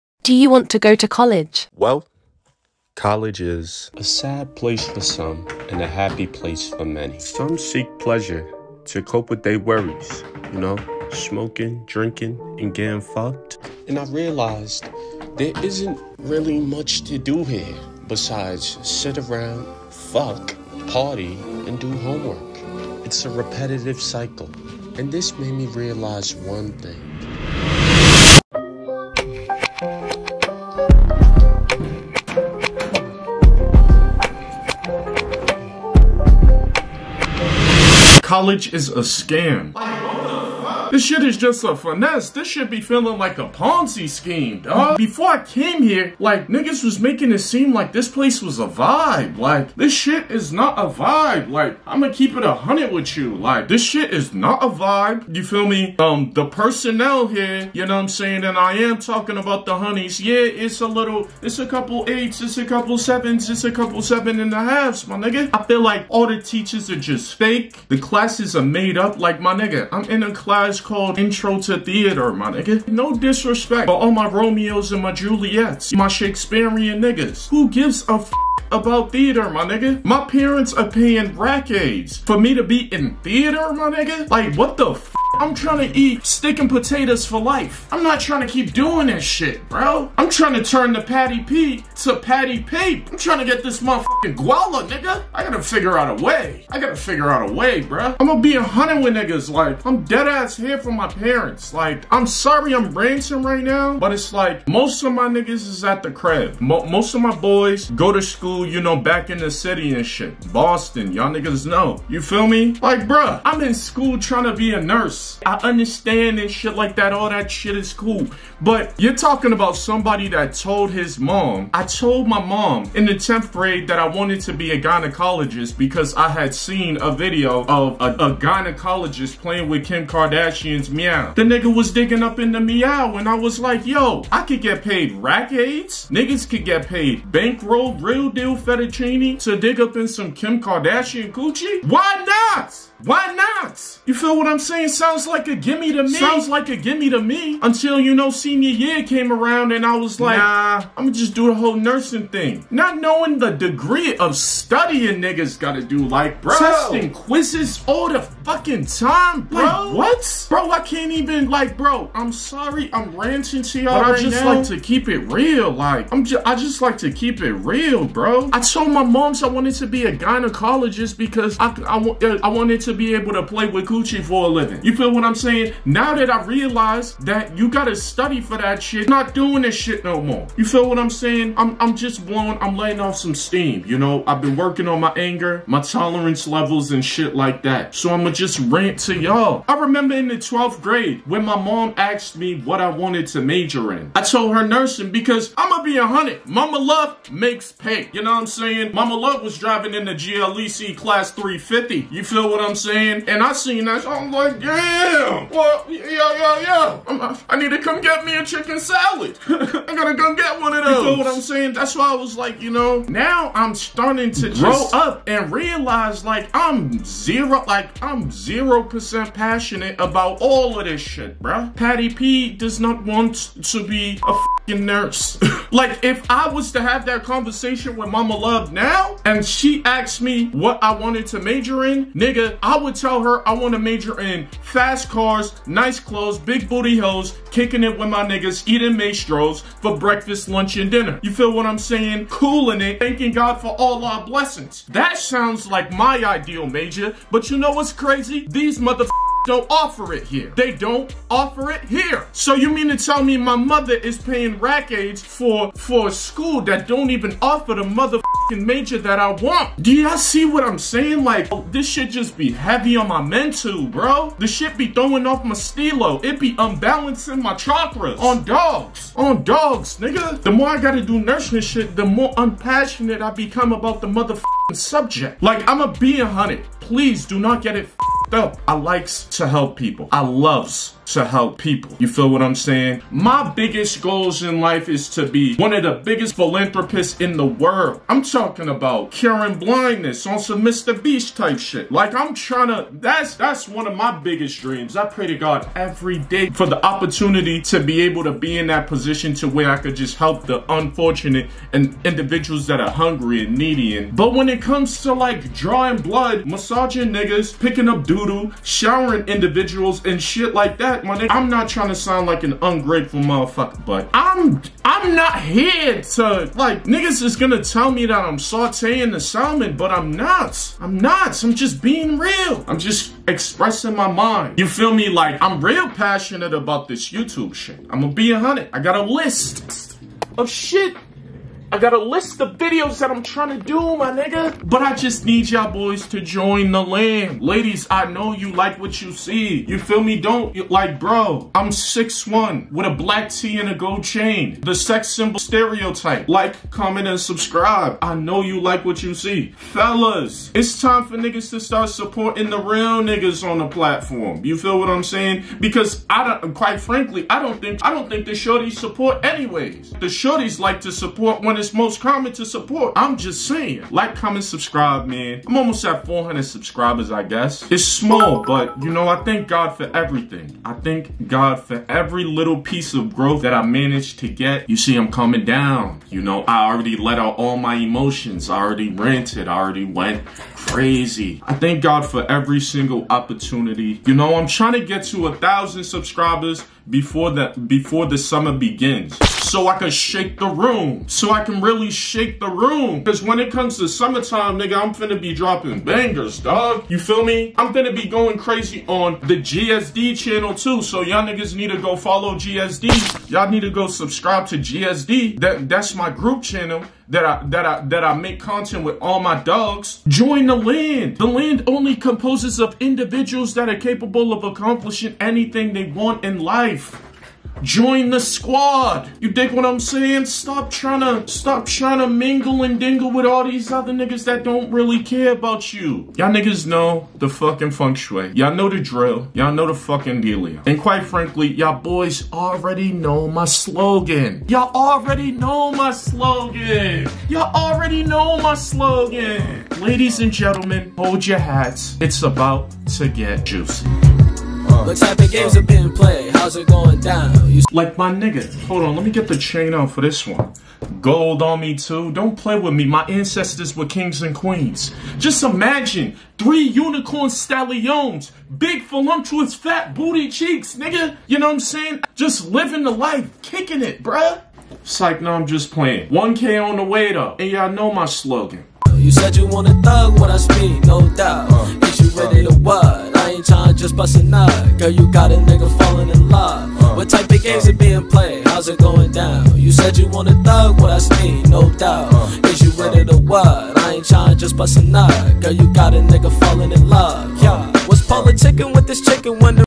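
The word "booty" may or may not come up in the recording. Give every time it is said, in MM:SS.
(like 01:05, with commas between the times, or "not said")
03:56, 07:39.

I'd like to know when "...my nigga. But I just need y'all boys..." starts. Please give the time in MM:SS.
05:33.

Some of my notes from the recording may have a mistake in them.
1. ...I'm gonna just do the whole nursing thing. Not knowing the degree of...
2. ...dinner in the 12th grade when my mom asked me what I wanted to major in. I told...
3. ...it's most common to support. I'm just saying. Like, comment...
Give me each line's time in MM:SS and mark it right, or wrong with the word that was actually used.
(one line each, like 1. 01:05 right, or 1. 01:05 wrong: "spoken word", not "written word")
1. 02:30 right
2. 03:09 wrong: "remember", not "dinner"
3. 06:01 right.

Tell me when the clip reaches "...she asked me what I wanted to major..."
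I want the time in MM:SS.
03:49.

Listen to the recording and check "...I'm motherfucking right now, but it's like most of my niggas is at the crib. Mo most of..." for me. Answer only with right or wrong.
wrong.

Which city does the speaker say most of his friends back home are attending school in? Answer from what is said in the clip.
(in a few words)
Boston.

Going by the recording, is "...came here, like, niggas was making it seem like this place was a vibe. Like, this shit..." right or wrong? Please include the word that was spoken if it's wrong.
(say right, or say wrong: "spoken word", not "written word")
right.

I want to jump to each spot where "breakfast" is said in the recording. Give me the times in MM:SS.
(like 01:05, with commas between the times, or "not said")
03:59.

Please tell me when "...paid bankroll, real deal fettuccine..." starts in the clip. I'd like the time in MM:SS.
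02:16.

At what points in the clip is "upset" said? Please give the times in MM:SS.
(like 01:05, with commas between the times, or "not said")
not said.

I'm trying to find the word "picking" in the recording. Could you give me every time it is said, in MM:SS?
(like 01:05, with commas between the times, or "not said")
05:07.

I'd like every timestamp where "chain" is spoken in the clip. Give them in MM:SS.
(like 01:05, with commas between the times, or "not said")
05:44, 07:29.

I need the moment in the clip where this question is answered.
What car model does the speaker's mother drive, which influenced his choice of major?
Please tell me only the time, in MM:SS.
03:20.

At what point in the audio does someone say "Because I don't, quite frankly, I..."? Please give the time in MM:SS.
05:55.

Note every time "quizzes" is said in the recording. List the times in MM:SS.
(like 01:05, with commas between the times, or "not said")
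02:37.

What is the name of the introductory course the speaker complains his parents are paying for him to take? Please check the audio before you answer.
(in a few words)
Intro to Theater.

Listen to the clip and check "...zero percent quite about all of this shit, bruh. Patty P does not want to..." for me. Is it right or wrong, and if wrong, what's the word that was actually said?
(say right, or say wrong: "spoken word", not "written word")
wrong: "passionate", not "quite".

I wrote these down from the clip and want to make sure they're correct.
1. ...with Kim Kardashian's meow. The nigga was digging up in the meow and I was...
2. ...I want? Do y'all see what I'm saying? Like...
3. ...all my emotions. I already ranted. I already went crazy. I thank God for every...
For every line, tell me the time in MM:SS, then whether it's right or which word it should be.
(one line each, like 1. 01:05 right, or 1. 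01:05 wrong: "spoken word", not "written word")
1. 02:09 right
2. 04:19 right
3. 06:17 right.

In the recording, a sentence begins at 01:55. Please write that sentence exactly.
I understand and shit like that.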